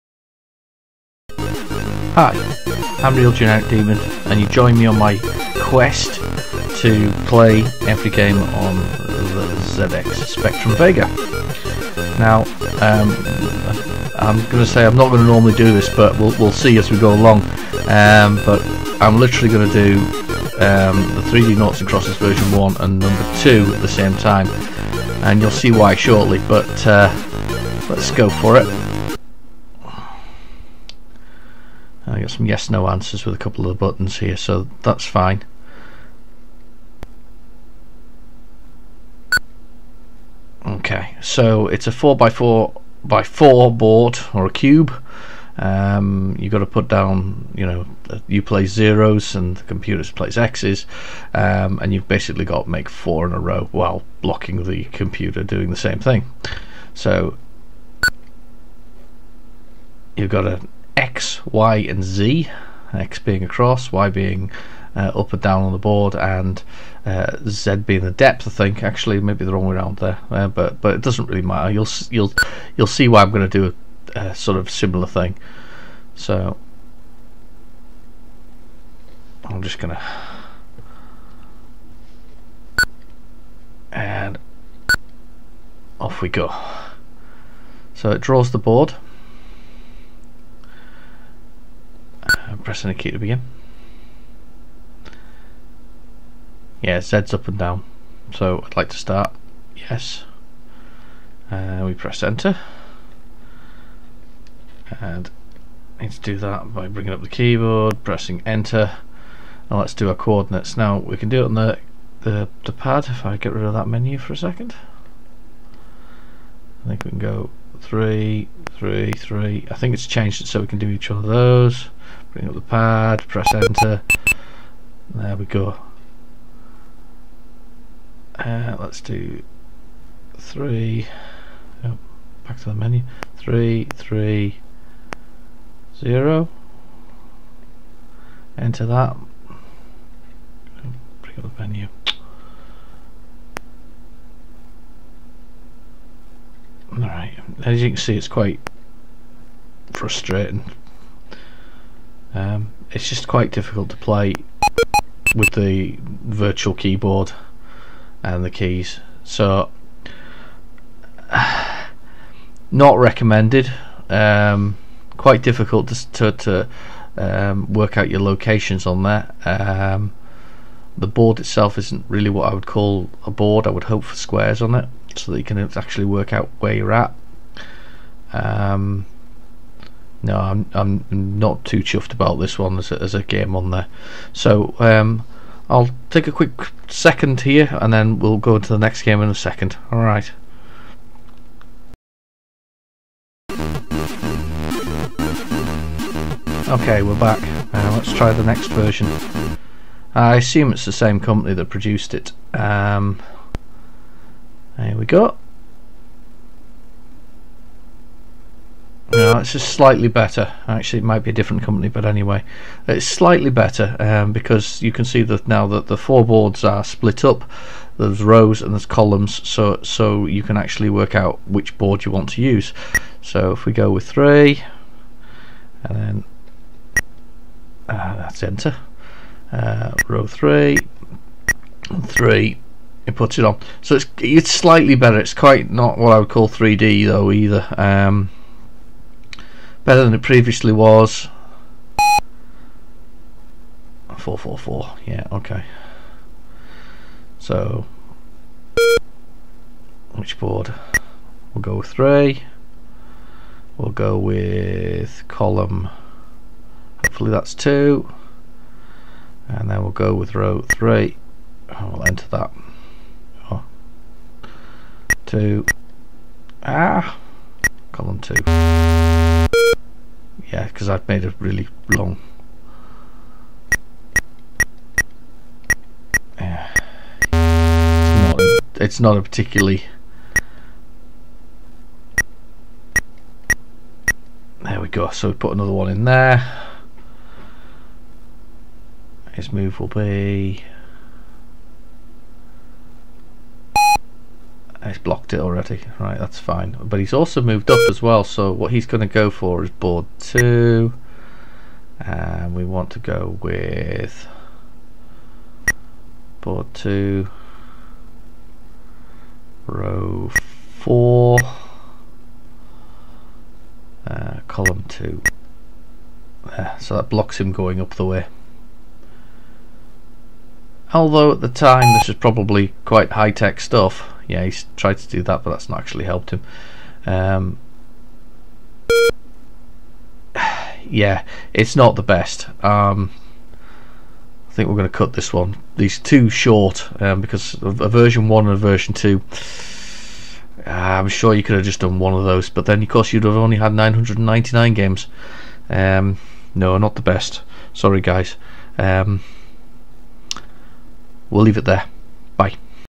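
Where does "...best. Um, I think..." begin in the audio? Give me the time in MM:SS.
05:32.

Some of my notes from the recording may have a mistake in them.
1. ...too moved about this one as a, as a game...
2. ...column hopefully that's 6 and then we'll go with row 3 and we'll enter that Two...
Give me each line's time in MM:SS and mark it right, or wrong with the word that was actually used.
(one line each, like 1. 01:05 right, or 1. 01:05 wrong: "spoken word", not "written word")
1. 03:01 wrong: "chuffed", not "moved"
2. 04:15 wrong: "2", not "6".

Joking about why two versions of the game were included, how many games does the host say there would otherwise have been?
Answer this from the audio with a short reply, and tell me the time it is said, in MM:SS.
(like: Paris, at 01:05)
999, at 05:43.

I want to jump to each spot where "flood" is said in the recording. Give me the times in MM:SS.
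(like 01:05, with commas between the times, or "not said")
not said.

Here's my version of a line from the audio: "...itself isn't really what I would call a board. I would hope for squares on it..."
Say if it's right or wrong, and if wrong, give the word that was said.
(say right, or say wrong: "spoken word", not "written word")
right.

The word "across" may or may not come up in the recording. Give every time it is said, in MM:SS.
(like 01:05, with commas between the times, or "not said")
01:03.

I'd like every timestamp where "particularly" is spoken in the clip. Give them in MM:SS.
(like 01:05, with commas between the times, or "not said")
04:39.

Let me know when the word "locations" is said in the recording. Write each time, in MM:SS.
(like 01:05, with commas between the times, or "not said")
02:48.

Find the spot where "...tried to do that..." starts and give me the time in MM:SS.
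05:24.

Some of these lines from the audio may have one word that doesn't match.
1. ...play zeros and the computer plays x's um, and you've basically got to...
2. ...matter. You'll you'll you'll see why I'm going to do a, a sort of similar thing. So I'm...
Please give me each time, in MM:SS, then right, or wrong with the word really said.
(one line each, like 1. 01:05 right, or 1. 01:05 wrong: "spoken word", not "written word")
1. 00:48 right
2. 01:11 right.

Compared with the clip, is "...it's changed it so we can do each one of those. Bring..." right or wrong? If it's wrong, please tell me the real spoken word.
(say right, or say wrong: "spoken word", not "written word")
right.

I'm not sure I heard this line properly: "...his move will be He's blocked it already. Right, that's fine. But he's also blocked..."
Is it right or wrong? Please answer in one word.
wrong.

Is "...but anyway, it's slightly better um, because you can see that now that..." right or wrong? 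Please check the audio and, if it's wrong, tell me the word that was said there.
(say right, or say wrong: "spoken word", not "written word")
right.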